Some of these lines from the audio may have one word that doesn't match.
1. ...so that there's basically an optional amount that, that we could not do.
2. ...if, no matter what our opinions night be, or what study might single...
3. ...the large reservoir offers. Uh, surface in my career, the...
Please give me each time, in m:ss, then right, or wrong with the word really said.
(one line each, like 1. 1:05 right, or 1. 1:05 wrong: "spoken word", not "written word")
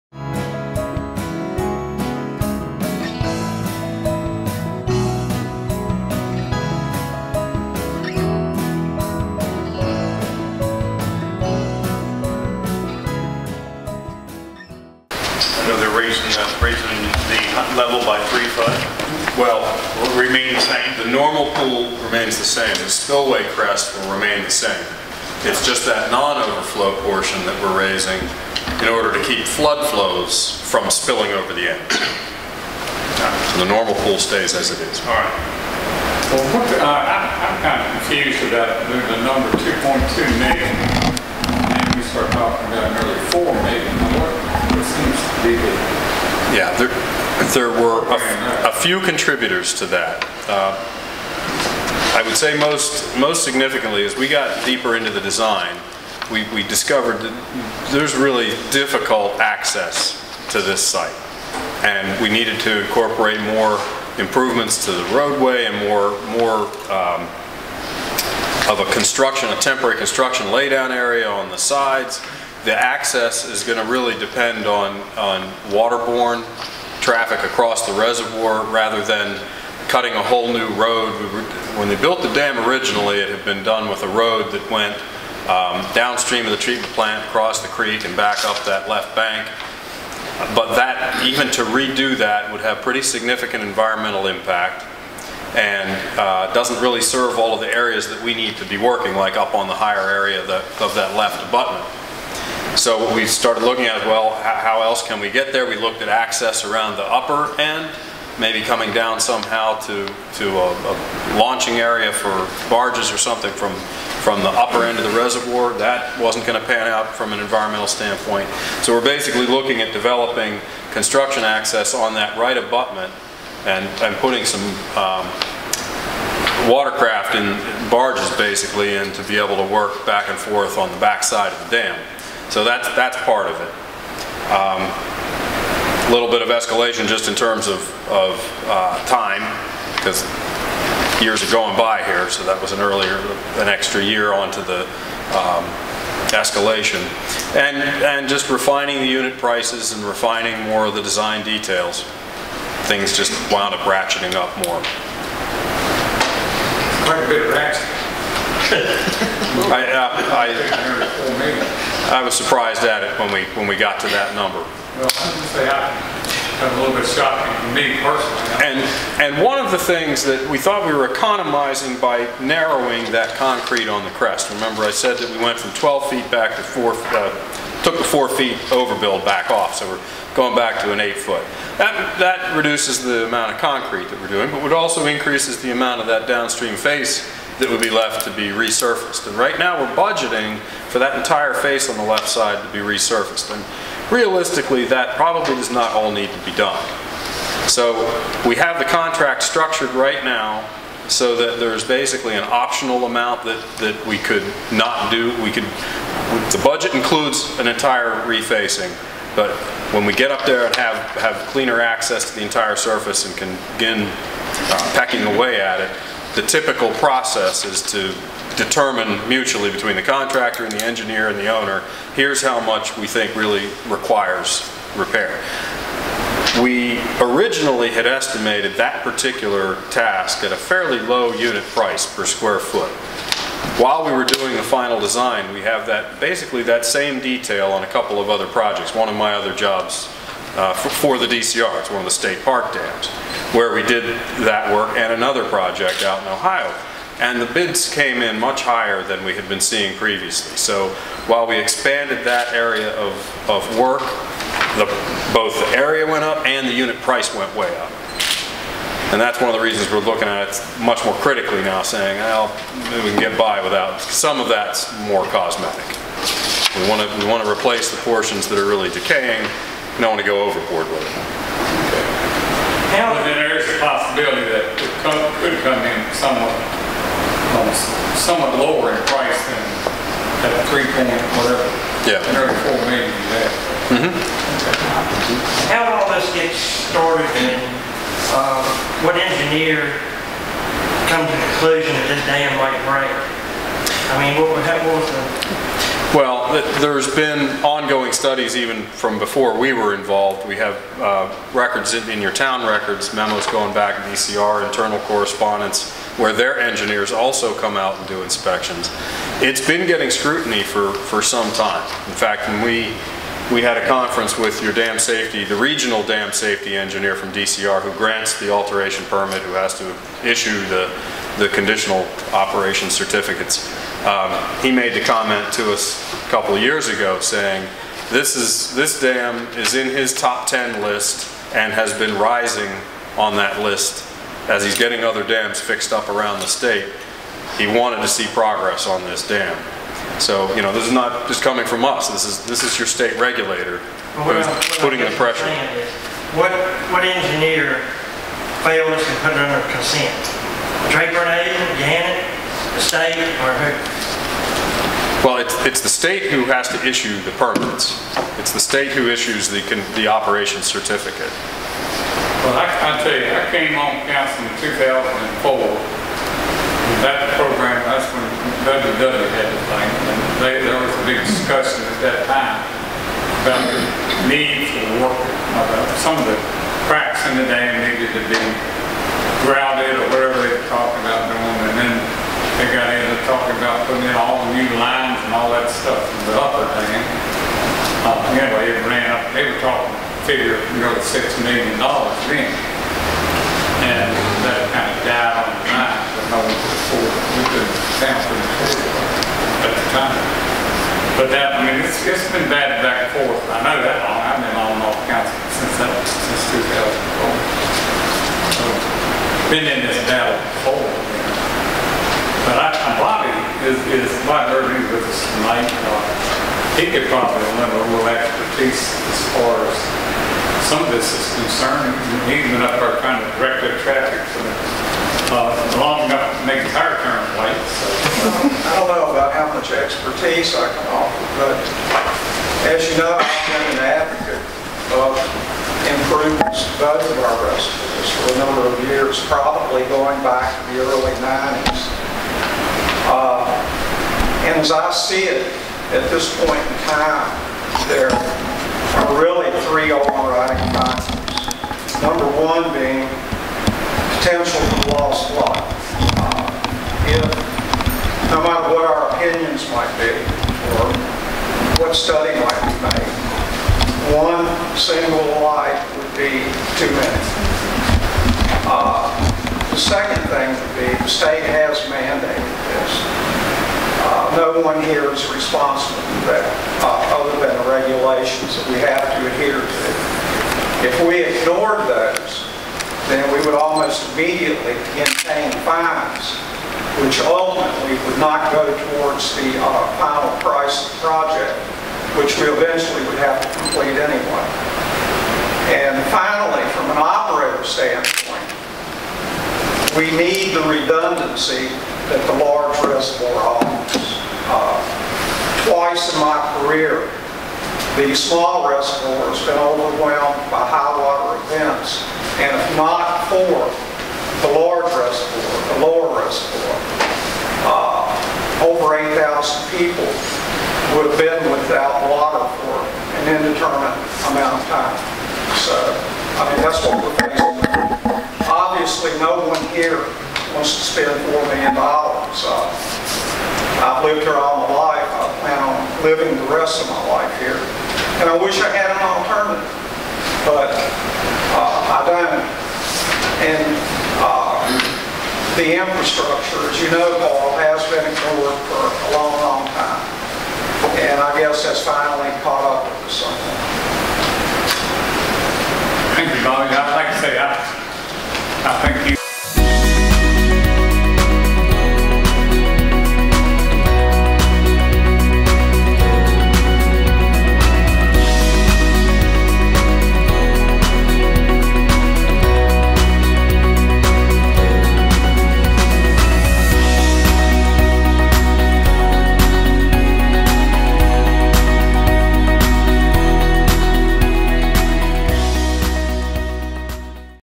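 1. 3:21 right
2. 7:37 wrong: "might", not "night"
3. 8:22 wrong: "twice", not "surface".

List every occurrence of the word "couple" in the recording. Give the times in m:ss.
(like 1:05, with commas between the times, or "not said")
3:57, 5:26.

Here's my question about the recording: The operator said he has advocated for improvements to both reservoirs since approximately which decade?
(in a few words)
early 90s.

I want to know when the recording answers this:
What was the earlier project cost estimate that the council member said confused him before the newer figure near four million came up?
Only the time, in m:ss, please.
0:39.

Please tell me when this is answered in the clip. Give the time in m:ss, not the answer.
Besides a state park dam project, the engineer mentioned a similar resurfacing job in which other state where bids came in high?
4:06.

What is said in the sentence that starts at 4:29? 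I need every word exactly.
We don't want to go overboard with it.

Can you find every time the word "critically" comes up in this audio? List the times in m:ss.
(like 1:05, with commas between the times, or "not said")
4:21.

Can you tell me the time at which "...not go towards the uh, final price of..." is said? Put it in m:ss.
8:08.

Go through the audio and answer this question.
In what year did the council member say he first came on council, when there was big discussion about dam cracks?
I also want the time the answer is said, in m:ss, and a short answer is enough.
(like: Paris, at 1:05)
2004, at 6:04.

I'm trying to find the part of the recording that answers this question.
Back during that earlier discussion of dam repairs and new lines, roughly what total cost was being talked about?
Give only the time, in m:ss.
6:30.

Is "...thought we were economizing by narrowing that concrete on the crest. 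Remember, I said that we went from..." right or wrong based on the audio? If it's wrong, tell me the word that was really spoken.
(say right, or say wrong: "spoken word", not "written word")
right.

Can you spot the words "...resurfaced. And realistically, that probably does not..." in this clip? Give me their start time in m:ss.
3:12.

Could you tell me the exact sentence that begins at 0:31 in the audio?
So the normal pool stays as it is.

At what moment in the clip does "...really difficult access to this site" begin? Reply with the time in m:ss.
0:58.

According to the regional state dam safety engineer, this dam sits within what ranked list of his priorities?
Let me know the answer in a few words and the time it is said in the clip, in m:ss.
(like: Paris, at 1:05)
top 10 list, at 5:30.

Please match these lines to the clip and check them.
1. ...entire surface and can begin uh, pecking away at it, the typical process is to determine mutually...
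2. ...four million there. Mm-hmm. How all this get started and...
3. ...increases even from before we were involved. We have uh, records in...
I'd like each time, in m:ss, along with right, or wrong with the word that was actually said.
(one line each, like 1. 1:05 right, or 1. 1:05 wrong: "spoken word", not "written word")
1. 3:32 right
2. 4:42 right
3. 4:58 wrong: "studies", not "increases".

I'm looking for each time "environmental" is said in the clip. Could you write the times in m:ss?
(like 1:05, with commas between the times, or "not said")
1:33, 1:57.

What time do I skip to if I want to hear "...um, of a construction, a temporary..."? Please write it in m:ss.
1:06.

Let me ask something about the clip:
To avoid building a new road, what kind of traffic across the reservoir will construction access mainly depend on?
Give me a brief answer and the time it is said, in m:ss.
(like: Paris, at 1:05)
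waterborne traffic, at 1:15.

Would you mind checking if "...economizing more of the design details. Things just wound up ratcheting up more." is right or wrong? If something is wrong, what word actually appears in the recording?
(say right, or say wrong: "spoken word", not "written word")
wrong: "refining", not "economizing".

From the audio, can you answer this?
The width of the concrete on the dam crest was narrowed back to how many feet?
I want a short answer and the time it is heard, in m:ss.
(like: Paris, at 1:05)
8 feet, at 3:00.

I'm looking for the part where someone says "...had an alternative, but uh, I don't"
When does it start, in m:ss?
8:58.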